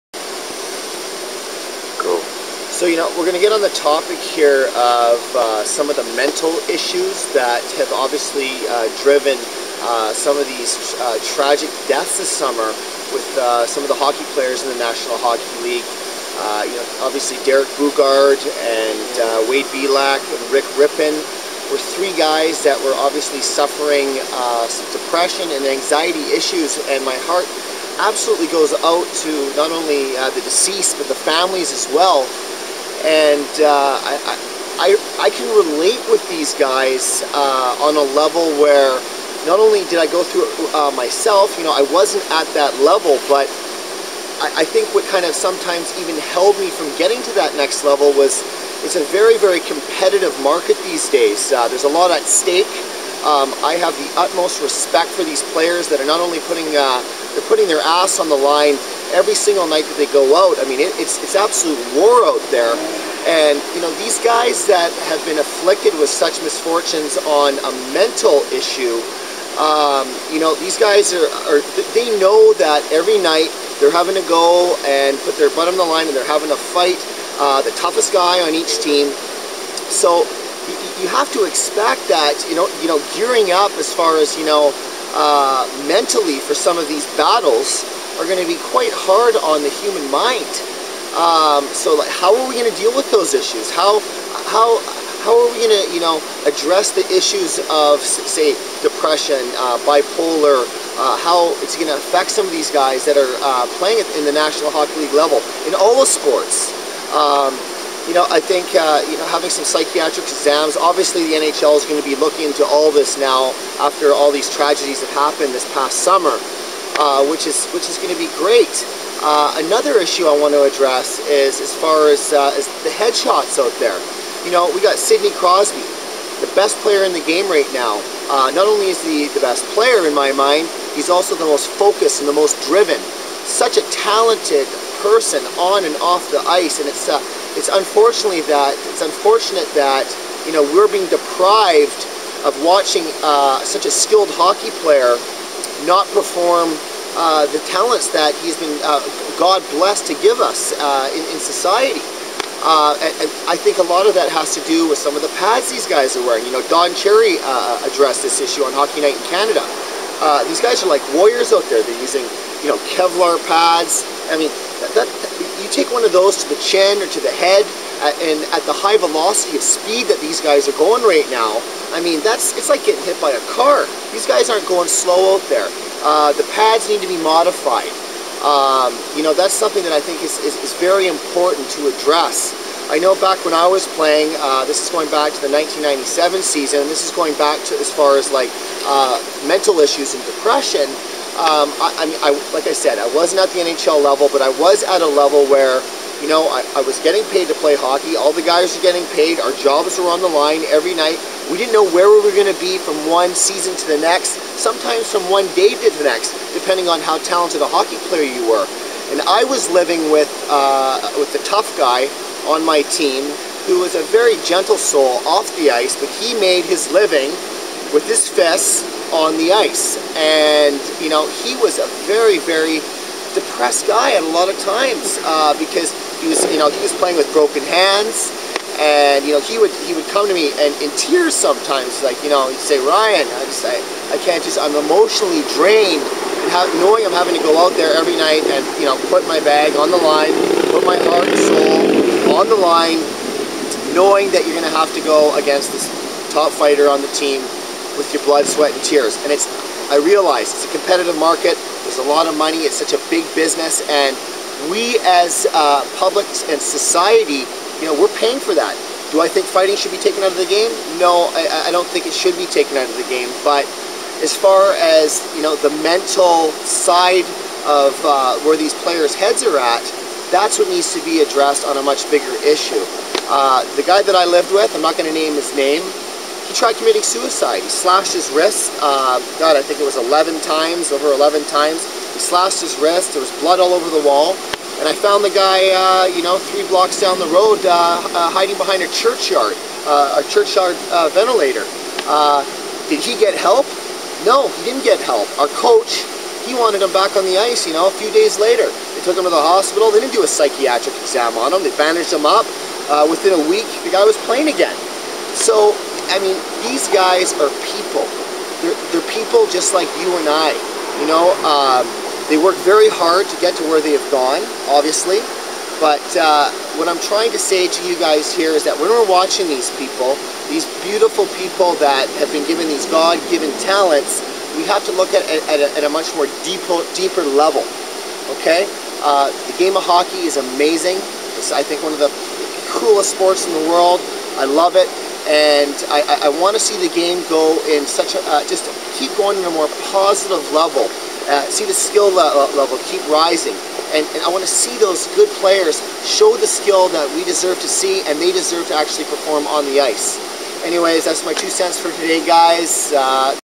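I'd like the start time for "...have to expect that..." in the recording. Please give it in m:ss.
1:21.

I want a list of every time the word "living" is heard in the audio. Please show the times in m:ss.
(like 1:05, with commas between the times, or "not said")
3:29, 3:36.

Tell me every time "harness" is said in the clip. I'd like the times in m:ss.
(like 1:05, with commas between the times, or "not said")
not said.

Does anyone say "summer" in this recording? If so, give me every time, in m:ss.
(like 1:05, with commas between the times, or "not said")
0:12, 1:56.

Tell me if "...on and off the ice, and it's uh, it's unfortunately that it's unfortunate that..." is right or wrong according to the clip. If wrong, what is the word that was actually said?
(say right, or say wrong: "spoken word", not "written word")
right.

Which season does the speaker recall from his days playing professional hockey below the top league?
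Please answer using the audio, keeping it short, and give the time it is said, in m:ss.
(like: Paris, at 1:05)
1997, at 3:05.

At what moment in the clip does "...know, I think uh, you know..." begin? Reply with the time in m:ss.
1:48.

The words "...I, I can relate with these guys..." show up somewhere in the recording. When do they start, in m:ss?
0:34.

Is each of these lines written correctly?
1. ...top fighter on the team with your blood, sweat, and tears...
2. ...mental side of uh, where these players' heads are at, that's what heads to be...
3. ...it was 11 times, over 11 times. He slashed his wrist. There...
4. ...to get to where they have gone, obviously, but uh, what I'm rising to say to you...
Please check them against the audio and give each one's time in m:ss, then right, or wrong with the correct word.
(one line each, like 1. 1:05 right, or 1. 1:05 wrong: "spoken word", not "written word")
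1. 4:06 right
2. 4:25 wrong: "needs", not "heads"
3. 4:39 right
4. 5:13 wrong: "trying", not "rising".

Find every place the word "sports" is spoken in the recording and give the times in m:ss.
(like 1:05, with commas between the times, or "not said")
1:46, 5:33.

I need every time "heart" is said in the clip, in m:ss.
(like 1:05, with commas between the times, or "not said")
0:27, 4:01.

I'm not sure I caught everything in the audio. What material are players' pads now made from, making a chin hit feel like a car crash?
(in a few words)
Kevlar.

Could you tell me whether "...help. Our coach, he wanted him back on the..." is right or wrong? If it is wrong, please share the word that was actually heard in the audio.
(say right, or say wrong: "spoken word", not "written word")
right.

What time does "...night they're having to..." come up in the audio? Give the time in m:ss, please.
1:13.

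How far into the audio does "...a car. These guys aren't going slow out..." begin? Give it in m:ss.
2:53.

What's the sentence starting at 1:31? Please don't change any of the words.
Um, so like, how are we going to deal with those issues?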